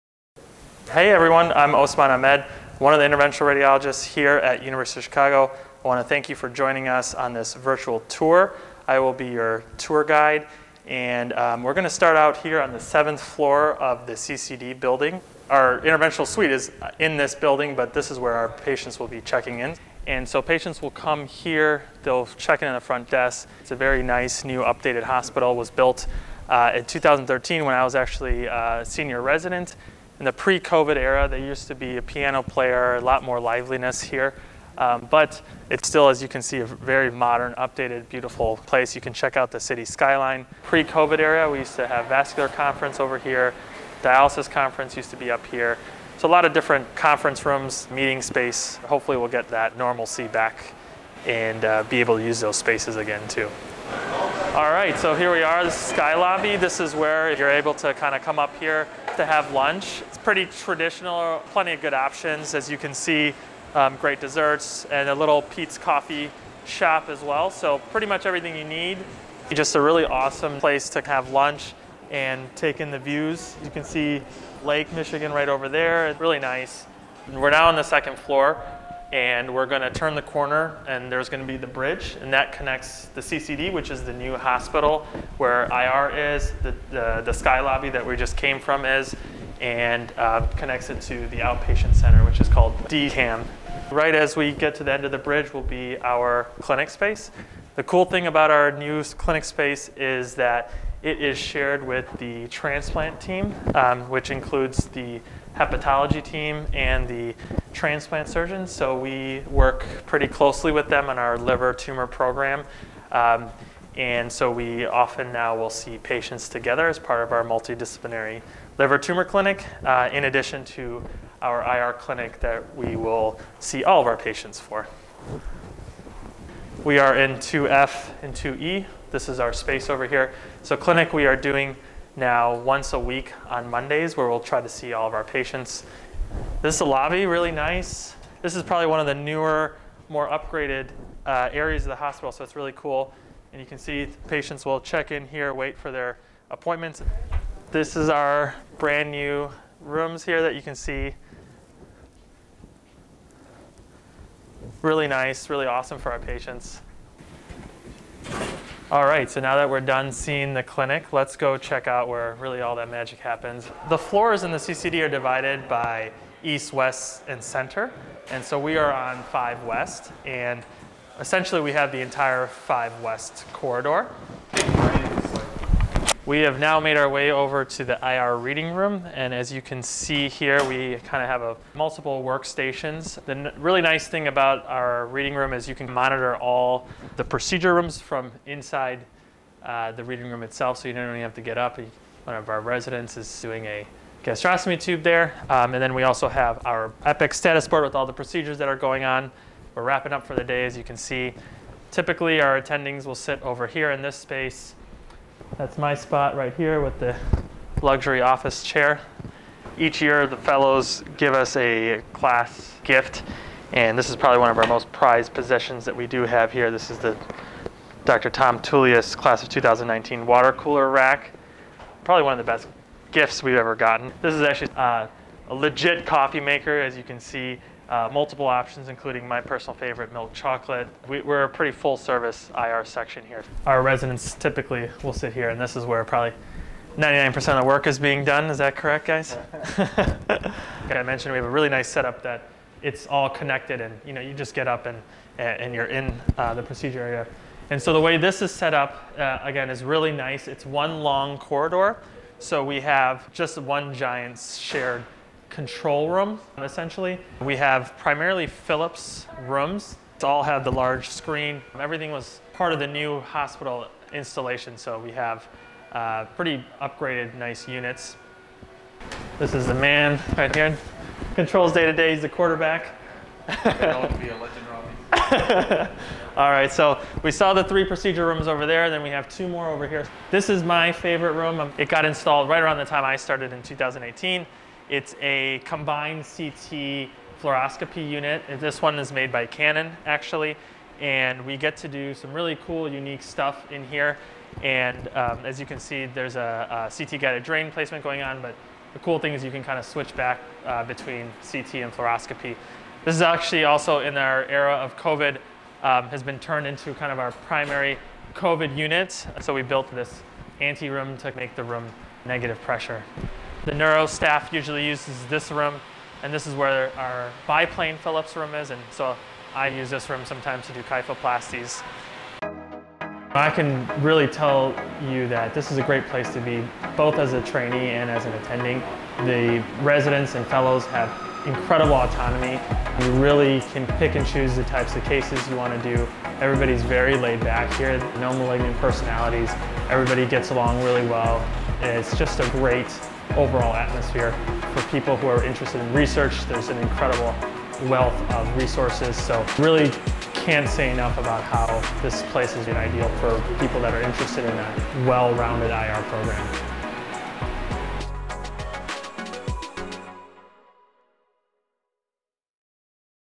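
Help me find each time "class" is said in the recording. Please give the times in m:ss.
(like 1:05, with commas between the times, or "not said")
3:32, 3:39.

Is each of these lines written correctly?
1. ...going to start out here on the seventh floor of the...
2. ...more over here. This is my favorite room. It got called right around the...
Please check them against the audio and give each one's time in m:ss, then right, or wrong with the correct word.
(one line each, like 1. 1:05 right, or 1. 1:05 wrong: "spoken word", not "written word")
1. 0:11 right
2. 4:39 wrong: "installed", not "called".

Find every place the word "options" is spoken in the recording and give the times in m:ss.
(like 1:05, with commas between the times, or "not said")
1:01, 3:48.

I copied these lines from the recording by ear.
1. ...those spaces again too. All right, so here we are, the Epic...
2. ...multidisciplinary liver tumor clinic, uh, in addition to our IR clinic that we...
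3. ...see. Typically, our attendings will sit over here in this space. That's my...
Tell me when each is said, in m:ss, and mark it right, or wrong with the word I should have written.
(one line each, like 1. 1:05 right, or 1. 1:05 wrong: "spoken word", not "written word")
1. 0:52 wrong: "Sky", not "Epic"
2. 1:57 right
3. 3:20 right.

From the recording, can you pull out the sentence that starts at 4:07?
And so the way this is set up, uh, again, is really nice.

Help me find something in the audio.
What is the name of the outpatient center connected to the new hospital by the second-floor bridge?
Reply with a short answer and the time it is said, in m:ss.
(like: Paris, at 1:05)
DCAM, at 1:32.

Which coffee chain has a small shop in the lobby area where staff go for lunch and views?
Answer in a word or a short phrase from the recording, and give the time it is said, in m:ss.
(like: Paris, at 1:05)
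Peet's Coffee, at 1:05.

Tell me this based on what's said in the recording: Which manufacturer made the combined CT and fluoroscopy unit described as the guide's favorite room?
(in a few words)
Canon.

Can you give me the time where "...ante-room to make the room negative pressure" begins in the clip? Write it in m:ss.
5:10.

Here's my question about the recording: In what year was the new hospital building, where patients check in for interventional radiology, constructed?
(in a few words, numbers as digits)
2013.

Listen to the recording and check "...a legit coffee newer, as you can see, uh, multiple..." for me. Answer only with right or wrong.
wrong.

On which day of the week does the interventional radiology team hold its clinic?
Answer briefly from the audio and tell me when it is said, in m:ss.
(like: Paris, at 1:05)
Mondays, at 2:13.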